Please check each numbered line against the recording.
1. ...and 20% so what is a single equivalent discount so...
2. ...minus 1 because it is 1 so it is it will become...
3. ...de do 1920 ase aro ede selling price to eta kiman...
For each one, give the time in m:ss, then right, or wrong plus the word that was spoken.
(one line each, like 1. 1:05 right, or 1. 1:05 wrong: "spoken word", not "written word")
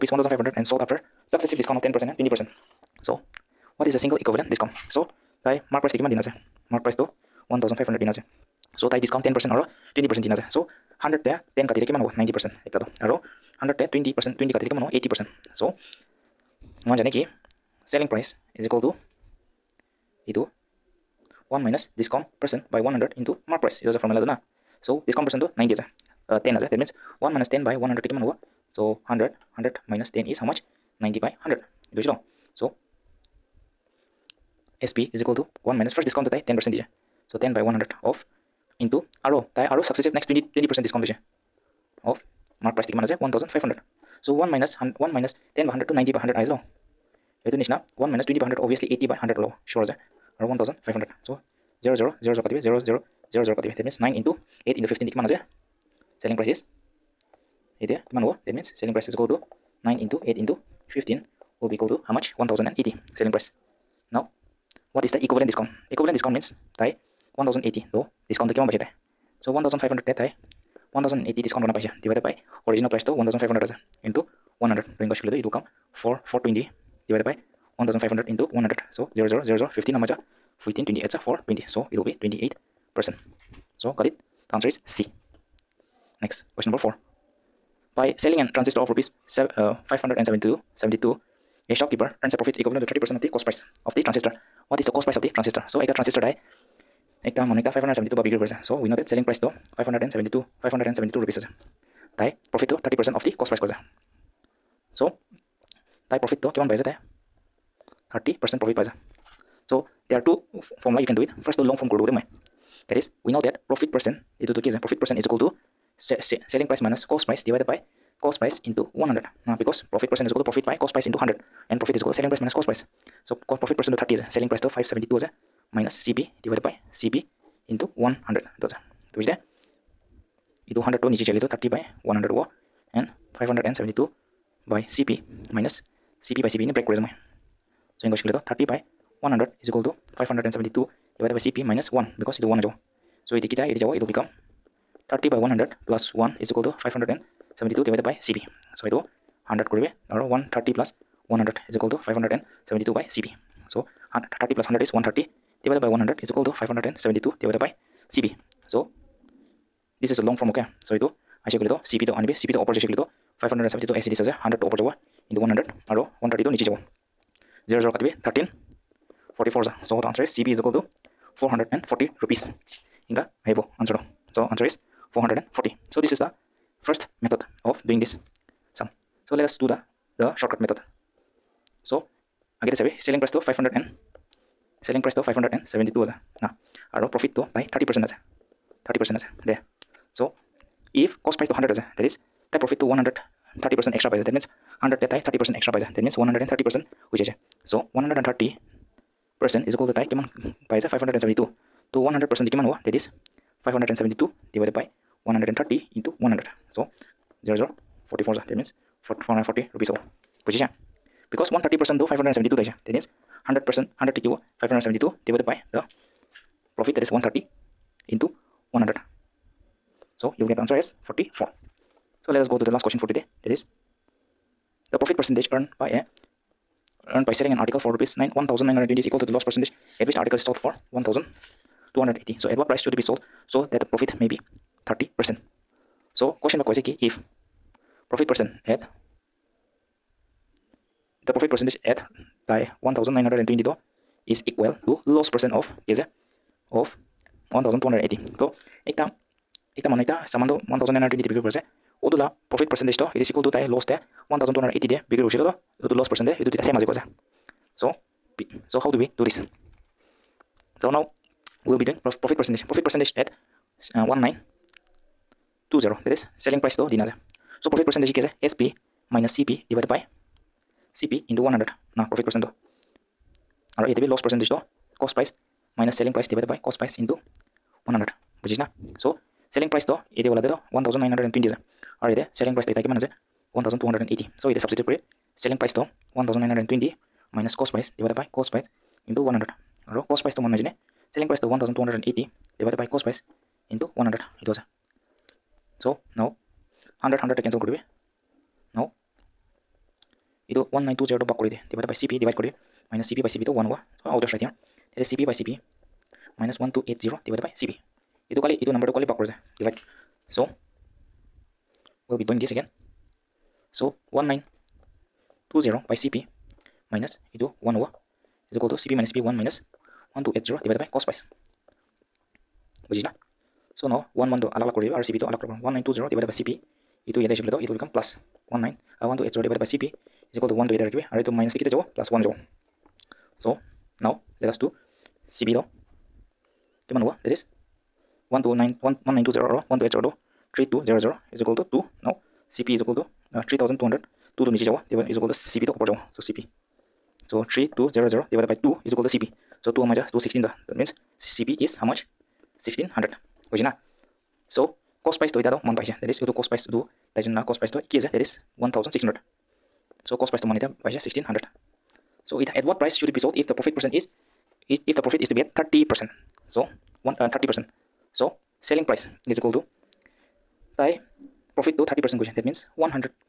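1. 0:02 right
2. 2:21 right
3. 4:40 right.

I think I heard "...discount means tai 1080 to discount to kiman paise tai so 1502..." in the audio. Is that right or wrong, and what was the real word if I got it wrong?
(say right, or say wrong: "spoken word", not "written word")
wrong: "1500", not "1502".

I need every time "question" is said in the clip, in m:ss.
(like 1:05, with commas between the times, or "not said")
1:26, 3:42.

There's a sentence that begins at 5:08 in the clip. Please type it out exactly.
Itu kali itu number to kali back kore divide.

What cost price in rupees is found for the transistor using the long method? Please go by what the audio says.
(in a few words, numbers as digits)
440 rupees.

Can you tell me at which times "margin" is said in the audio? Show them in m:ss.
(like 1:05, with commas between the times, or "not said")
1:48.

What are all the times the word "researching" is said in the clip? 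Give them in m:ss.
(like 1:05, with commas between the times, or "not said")
not said.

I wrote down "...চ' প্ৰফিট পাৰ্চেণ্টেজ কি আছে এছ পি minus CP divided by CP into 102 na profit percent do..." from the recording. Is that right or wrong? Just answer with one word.
wrong.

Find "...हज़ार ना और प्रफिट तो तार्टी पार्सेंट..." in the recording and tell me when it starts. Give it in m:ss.
3:06.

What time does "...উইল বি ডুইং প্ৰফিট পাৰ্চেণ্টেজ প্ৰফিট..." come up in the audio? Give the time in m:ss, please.
4:21.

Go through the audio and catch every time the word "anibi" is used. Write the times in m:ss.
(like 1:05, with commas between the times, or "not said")
2:42.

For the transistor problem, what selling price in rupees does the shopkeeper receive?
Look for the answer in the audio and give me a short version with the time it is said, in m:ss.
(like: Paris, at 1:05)
572, at 1:40.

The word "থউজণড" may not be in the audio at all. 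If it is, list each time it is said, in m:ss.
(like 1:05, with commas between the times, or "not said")
0:43, 0:50, 4:14.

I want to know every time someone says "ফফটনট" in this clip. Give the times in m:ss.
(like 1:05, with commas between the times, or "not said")
0:54.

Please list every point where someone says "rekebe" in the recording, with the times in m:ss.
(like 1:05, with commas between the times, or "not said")
5:30.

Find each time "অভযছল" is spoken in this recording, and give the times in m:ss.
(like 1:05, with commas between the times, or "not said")
0:48.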